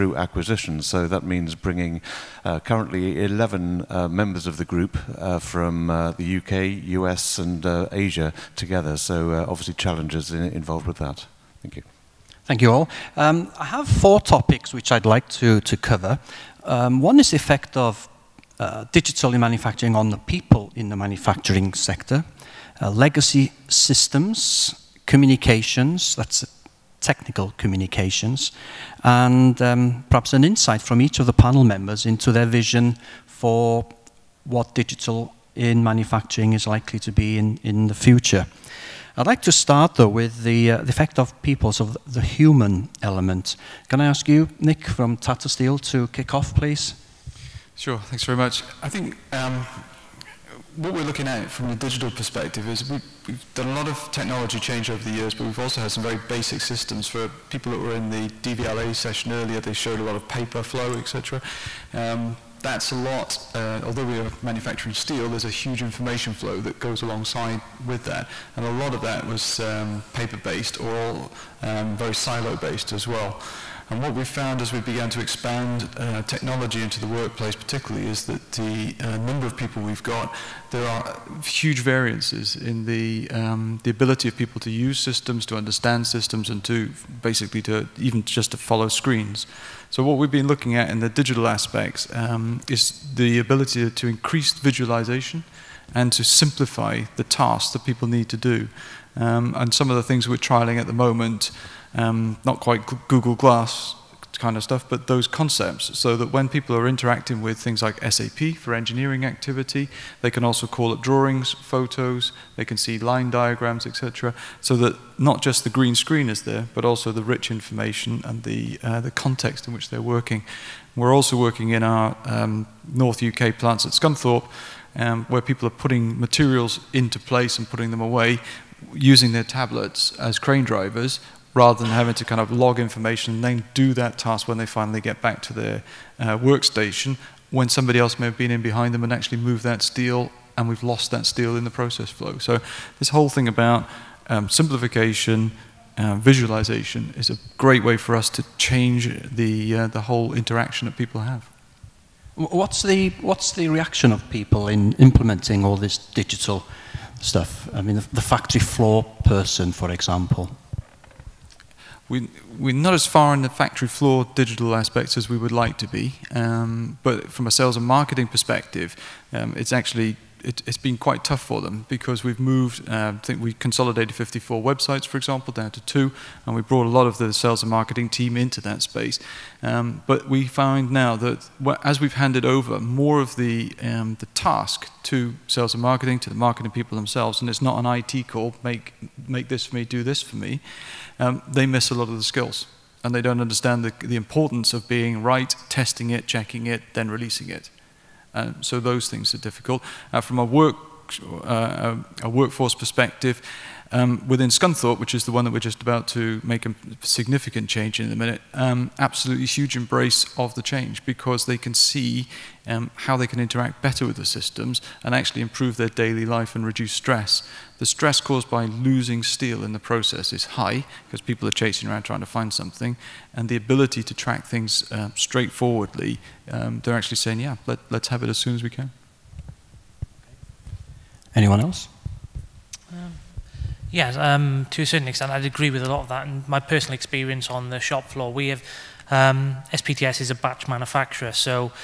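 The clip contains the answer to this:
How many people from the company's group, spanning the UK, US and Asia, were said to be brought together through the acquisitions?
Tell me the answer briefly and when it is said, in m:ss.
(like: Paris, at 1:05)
11, at 0:03.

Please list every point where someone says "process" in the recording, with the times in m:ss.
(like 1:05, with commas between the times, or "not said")
2:21, 3:39.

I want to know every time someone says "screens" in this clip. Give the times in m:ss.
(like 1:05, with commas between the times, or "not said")
1:28, 1:55.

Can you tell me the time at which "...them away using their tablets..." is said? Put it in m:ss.
2:07.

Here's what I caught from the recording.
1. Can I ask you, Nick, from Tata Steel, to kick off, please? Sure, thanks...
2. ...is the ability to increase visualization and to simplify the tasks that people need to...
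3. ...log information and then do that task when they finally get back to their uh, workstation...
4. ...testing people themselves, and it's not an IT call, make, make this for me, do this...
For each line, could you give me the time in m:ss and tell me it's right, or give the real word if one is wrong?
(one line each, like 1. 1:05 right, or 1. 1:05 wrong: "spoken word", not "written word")
1. 0:43 right
2. 1:32 right
3. 2:12 right
4. 3:06 wrong: "marketing", not "testing".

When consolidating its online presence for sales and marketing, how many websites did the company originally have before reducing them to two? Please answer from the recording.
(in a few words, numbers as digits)
54.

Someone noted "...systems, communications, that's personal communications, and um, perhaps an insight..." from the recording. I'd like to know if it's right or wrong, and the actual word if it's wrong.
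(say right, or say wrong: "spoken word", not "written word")
wrong: "technical", not "personal".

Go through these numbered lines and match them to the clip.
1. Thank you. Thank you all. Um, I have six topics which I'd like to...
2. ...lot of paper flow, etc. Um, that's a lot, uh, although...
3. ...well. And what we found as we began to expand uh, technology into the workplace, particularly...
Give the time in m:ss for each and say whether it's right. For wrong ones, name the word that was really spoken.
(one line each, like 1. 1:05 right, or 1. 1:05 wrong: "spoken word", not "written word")
1. 0:11 wrong: "four", not "six"
2. 1:00 right
3. 1:13 right.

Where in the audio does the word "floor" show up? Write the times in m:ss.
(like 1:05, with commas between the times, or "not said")
2:38, 2:43, 3:58.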